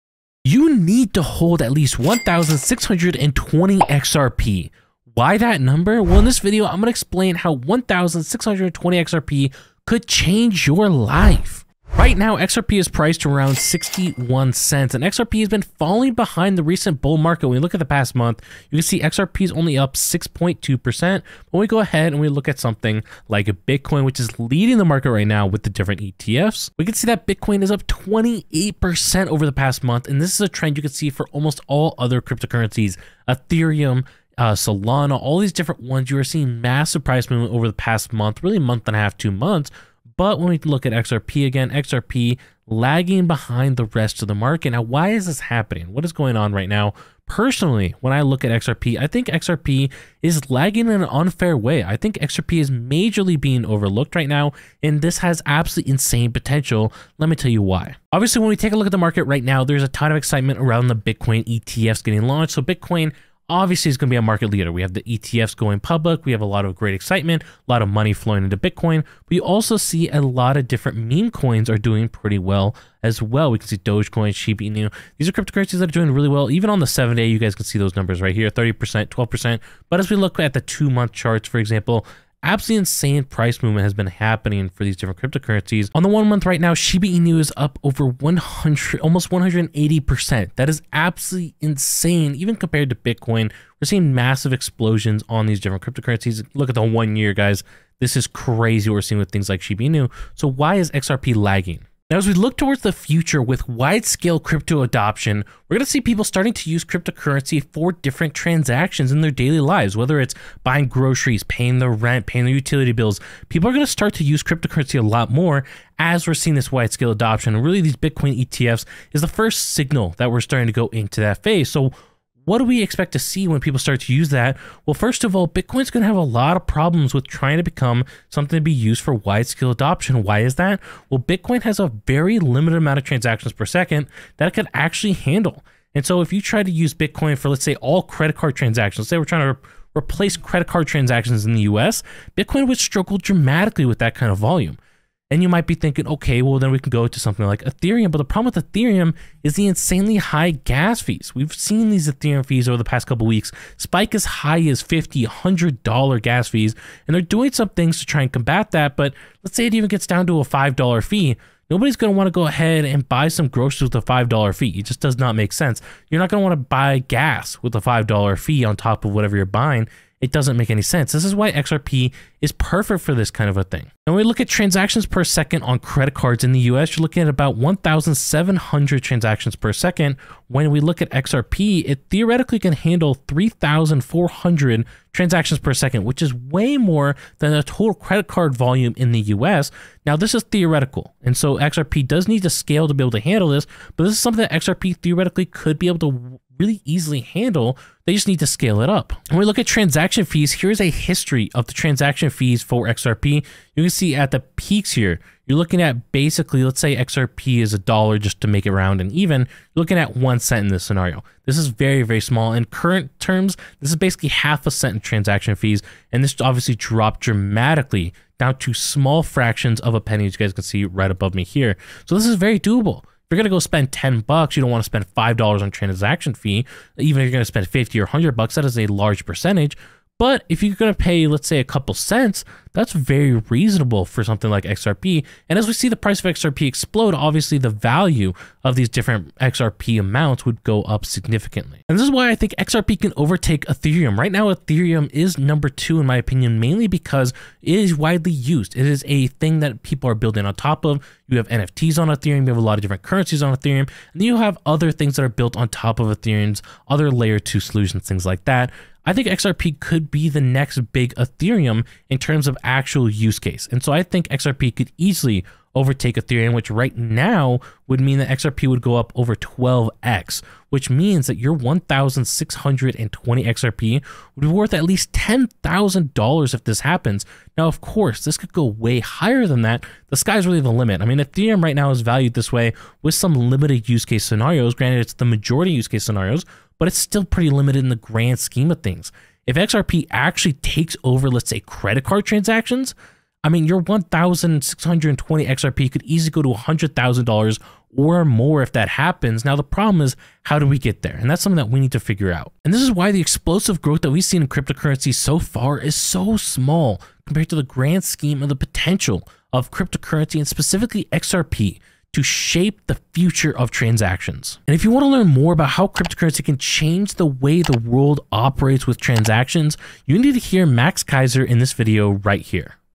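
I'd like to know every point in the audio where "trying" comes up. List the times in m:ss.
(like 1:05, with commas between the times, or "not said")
2:07, 2:19.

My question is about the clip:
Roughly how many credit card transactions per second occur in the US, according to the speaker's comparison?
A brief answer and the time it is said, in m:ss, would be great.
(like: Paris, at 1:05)
1,700, at 2:57.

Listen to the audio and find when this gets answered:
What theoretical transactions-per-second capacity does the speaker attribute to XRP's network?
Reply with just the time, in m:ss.
3:03.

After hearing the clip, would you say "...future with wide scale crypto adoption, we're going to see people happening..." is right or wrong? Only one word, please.
wrong.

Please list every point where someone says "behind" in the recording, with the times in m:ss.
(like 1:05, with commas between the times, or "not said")
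0:16, 0:43.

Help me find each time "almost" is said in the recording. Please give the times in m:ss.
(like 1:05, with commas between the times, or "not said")
0:31, 1:29.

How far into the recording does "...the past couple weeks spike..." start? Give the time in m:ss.
2:32.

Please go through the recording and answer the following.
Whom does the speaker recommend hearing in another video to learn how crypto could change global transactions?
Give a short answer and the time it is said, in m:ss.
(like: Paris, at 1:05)
Max Keiser, at 5:20.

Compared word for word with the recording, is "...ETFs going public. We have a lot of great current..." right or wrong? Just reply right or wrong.
wrong.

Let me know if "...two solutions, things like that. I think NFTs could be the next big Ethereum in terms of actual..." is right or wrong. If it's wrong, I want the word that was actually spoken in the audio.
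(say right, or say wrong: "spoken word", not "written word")
wrong: "XRP", not "NFTs".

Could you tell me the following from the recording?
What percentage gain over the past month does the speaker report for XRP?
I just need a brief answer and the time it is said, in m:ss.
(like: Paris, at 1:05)
6.2%, at 0:19.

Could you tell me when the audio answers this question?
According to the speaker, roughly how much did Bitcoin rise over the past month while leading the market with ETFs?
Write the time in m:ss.
0:27.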